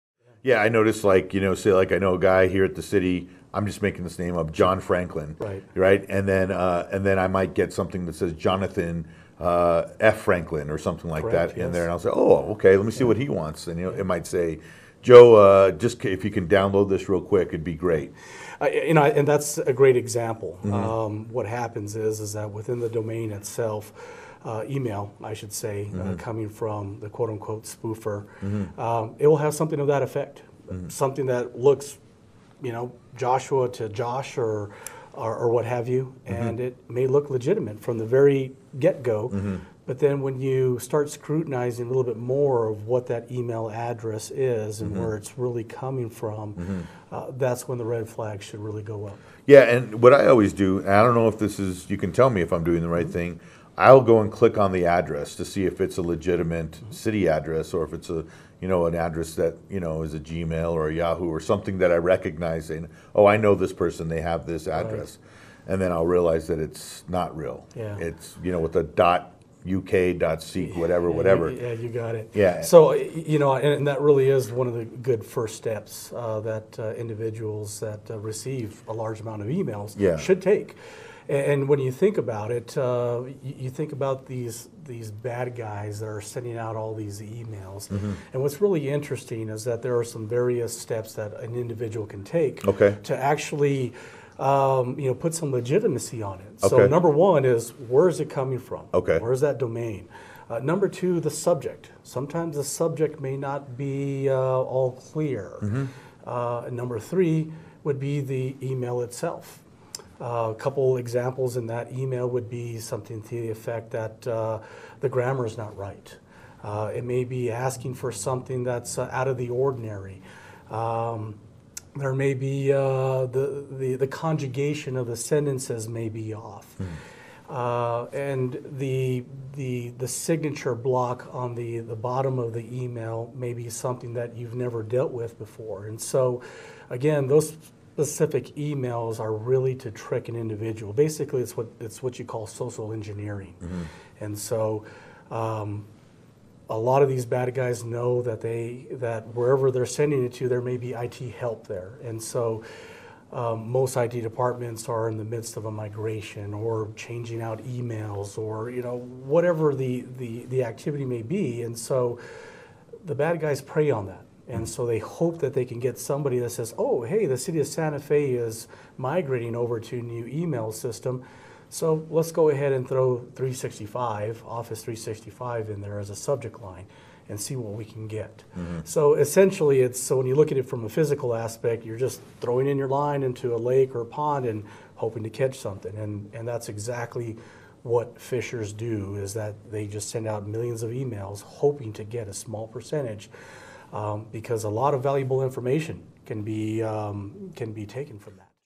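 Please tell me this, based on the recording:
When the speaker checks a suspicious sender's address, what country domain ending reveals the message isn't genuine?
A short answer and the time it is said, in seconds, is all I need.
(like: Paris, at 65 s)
.uk, at 68 s.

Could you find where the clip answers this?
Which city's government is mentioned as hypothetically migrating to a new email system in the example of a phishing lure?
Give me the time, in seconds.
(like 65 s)
167 s.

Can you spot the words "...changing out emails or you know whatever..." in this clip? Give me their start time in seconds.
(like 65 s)
156 s.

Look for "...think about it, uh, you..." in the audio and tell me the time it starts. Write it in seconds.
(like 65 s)
81 s.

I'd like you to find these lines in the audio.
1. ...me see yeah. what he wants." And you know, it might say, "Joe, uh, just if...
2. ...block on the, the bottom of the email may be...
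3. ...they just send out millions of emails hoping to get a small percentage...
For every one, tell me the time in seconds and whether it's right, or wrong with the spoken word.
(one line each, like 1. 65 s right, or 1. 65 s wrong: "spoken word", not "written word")
1. 12 s right
2. 130 s right
3. 189 s right.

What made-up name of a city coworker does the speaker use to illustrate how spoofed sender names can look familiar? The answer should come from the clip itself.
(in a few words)
John Franklin.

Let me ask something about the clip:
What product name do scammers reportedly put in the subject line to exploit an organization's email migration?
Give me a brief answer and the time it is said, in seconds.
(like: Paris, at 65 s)
Office 365, at 174 s.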